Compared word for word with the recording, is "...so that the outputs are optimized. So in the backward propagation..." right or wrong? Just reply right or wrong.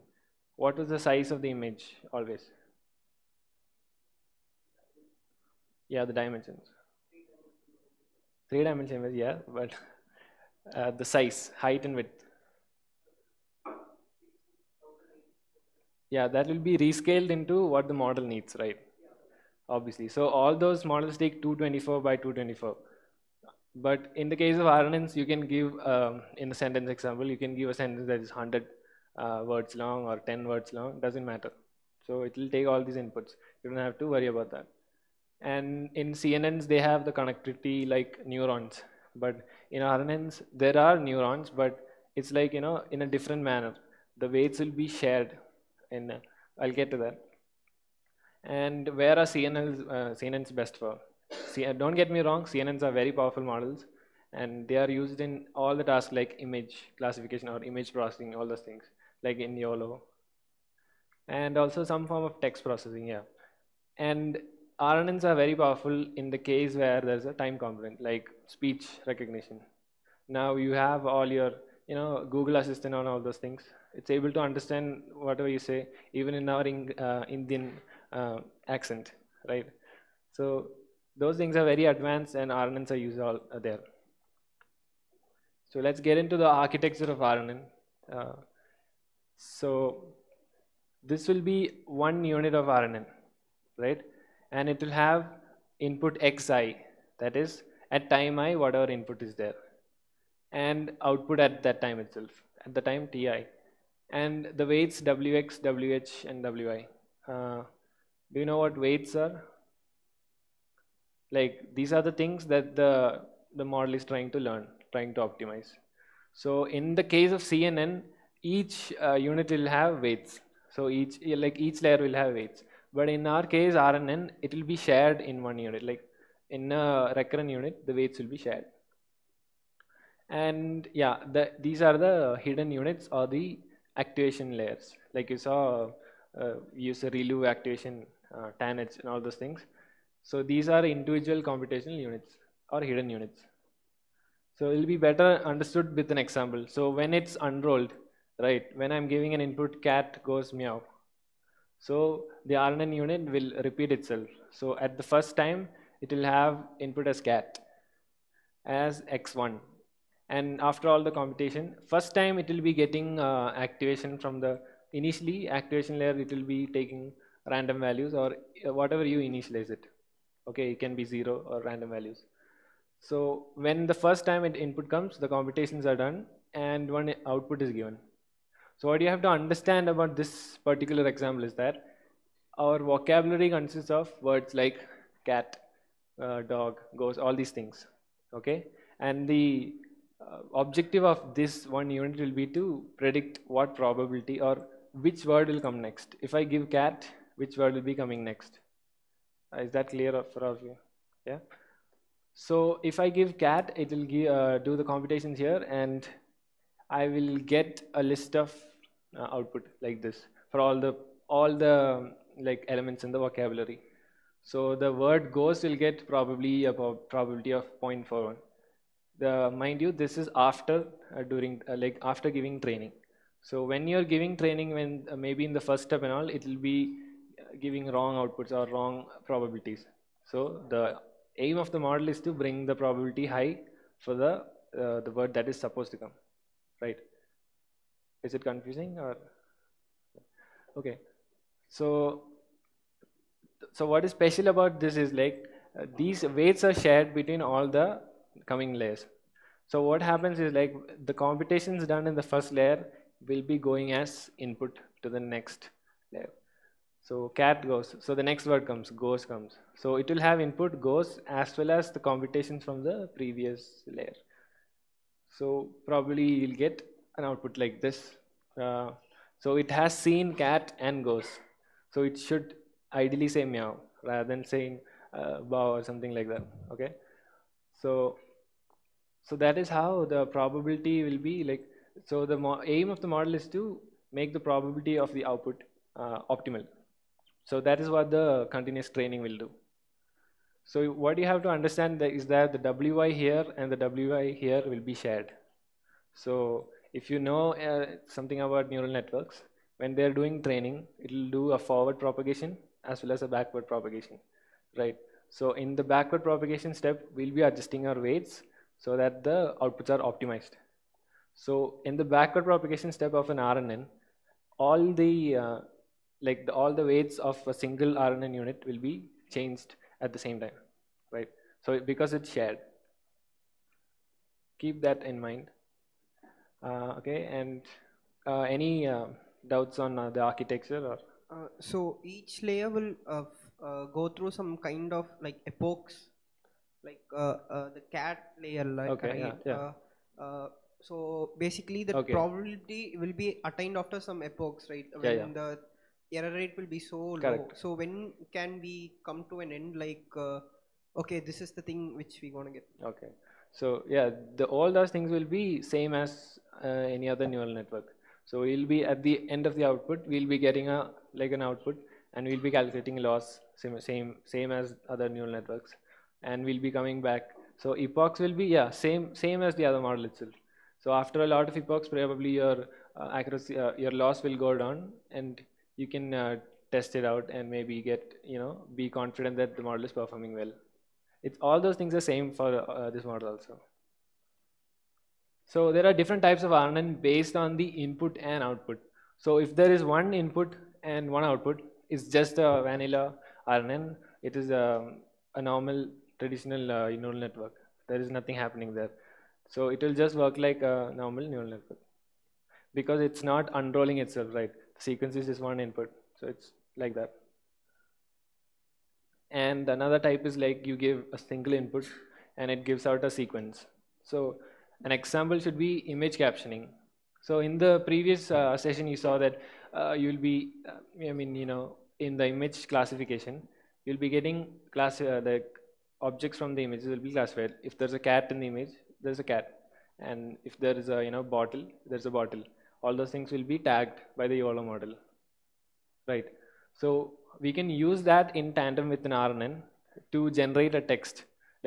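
right.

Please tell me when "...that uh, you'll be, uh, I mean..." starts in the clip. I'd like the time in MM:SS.
06:59.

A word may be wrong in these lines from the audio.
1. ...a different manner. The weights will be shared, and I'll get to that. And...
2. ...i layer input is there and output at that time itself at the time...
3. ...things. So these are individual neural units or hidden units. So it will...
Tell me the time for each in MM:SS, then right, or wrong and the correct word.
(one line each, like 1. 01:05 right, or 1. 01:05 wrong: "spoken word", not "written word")
1. 00:43 right
2. 01:38 wrong: "whatever", not "layer"
3. 02:19 wrong: "computational", not "neural".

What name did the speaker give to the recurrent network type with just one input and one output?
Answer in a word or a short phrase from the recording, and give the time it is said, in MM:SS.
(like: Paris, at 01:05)
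vanilla RNN, at 06:32.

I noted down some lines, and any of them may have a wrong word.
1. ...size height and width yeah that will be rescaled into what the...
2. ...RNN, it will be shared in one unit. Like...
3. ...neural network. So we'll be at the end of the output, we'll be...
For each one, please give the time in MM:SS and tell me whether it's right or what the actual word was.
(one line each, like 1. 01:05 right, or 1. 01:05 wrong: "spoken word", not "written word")
1. 00:11 right
2. 02:03 right
3. 05:57 right.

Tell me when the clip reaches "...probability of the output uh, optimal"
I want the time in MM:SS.
04:44.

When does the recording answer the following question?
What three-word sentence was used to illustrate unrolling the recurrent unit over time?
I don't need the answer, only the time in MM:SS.
02:29.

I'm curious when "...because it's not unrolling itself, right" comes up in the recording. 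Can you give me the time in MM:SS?
06:42.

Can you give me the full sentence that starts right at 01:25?
So let's get into the architecture of RNN.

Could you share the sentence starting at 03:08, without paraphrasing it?
And the uh, objective of this one unit will be to predict what probability or which word will come next.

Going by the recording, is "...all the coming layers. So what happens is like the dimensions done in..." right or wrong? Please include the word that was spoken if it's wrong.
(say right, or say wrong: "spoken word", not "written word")
wrong: "computations", not "dimensions".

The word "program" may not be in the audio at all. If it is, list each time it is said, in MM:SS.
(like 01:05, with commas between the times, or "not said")
not said.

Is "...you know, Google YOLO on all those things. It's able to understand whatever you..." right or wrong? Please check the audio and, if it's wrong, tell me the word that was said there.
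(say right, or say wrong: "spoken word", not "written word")
wrong: "Assistant", not "YOLO".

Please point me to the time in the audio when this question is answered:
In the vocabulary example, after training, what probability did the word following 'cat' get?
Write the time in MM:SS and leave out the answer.
03:37.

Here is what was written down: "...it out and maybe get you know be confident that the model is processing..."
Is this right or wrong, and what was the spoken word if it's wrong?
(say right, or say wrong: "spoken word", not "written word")
wrong: "performing", not "processing".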